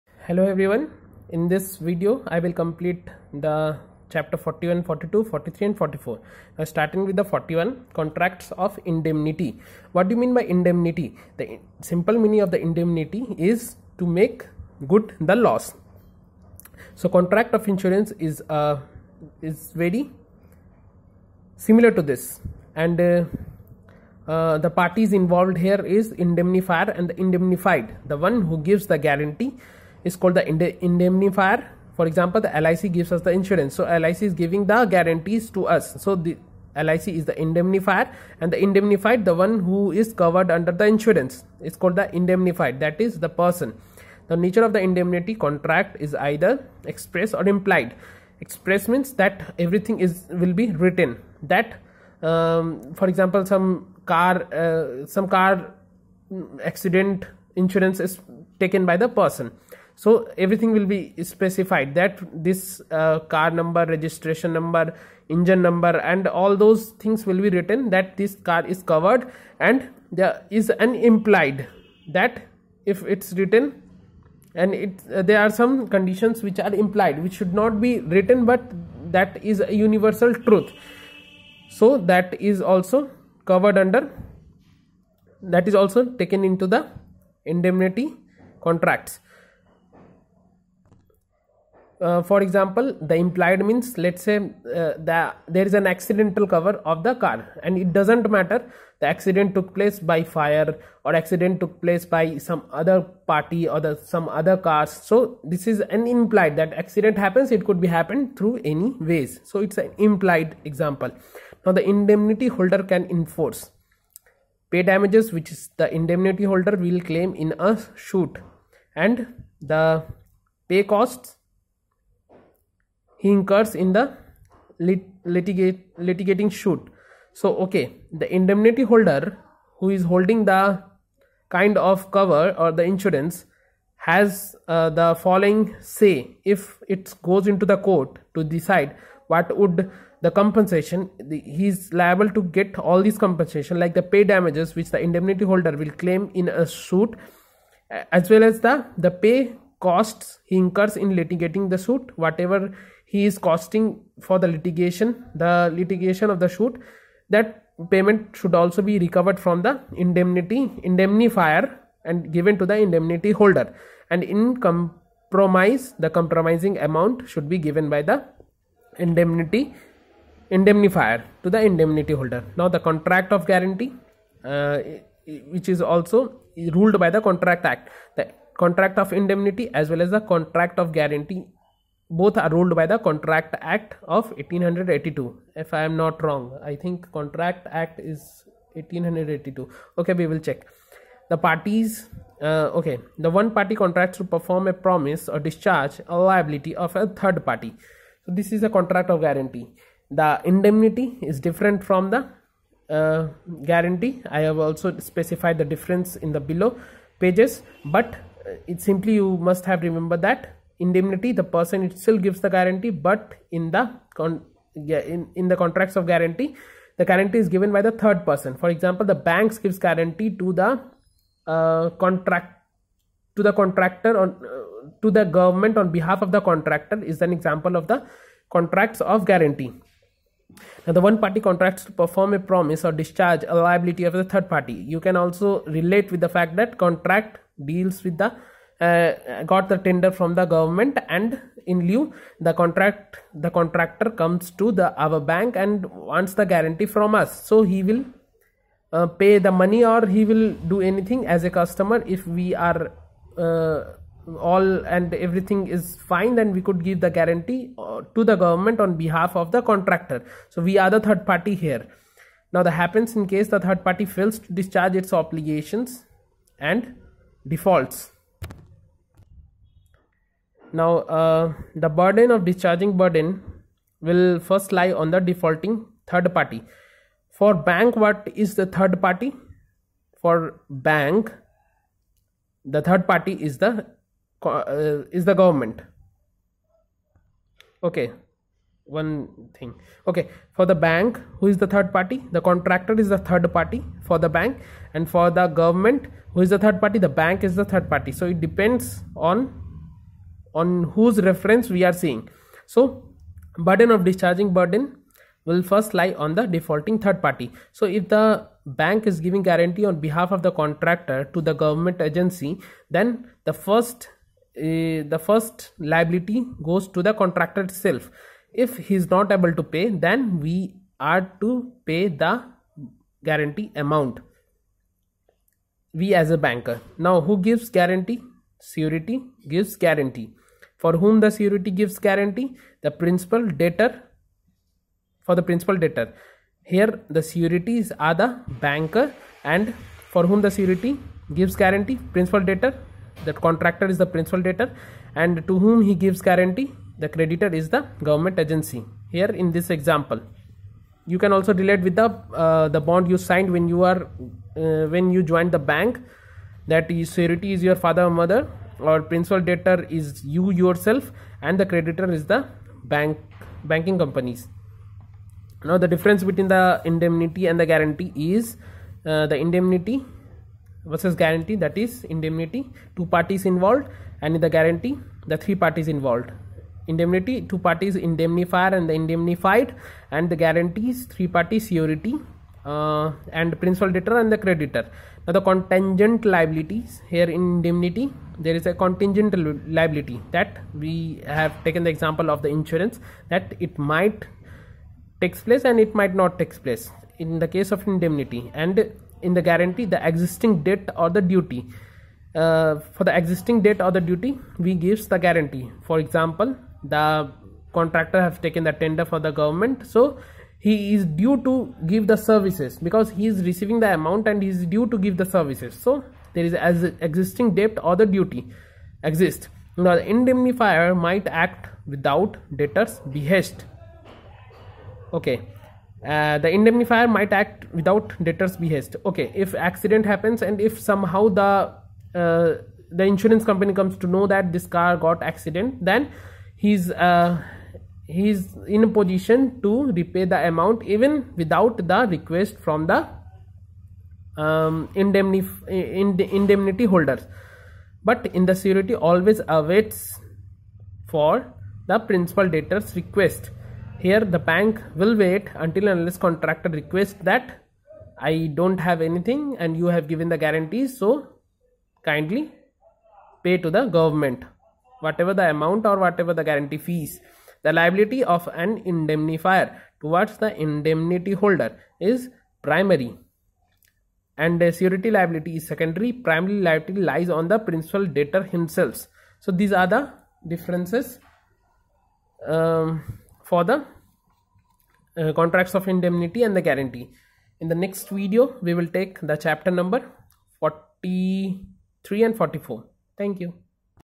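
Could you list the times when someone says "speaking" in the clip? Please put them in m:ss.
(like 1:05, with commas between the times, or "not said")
not said.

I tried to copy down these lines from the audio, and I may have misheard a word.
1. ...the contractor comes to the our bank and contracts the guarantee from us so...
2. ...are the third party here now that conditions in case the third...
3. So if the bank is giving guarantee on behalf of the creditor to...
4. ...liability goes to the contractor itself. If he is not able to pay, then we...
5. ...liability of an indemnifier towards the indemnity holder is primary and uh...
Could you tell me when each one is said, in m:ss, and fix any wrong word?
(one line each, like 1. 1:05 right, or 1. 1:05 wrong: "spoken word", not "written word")
1. 4:03 wrong: "wants", not "contracts"
2. 4:20 wrong: "happens", not "conditions"
3. 5:07 wrong: "contractor", not "creditor"
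4. 5:15 right
5. 7:47 right.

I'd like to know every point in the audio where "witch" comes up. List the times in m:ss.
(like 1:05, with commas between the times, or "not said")
not said.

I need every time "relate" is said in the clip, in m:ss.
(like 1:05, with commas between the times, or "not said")
3:55, 5:51.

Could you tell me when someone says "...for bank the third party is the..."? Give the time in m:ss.
4:40.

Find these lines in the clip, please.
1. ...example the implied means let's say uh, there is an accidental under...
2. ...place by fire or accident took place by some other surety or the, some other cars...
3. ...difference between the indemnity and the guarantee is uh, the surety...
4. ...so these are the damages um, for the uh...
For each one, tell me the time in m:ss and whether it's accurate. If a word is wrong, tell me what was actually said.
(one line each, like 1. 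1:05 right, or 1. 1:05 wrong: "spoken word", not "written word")
1. 1:32 wrong: "cover", not "under"
2. 1:39 wrong: "party", not "surety"
3. 6:05 wrong: "indemnity", not "surety"
4. 7:59 wrong: "differences", not "damages".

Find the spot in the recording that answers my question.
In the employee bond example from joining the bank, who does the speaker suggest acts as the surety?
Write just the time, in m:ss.
5:57.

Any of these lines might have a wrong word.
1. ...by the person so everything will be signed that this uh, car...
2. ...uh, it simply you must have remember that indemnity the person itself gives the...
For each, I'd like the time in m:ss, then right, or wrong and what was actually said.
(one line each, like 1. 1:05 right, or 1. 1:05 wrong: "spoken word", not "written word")
1. 0:58 wrong: "specified", not "signed"
2. 3:28 right.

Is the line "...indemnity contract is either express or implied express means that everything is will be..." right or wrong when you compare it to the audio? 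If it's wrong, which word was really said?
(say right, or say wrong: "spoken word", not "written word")
right.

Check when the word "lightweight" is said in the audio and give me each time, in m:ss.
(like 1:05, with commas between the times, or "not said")
not said.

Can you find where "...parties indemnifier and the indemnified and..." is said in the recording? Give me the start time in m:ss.
6:17.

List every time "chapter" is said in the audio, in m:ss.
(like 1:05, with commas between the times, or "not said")
0:04, 8:09.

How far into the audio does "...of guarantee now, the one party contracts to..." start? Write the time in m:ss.
3:49.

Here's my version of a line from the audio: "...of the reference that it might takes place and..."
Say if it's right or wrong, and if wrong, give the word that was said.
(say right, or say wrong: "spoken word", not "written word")
wrong: "insurance", not "reference".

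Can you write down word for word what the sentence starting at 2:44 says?
And in compromise, the compromising amount should be given by the indemnity indemnifier to the indemnity holder.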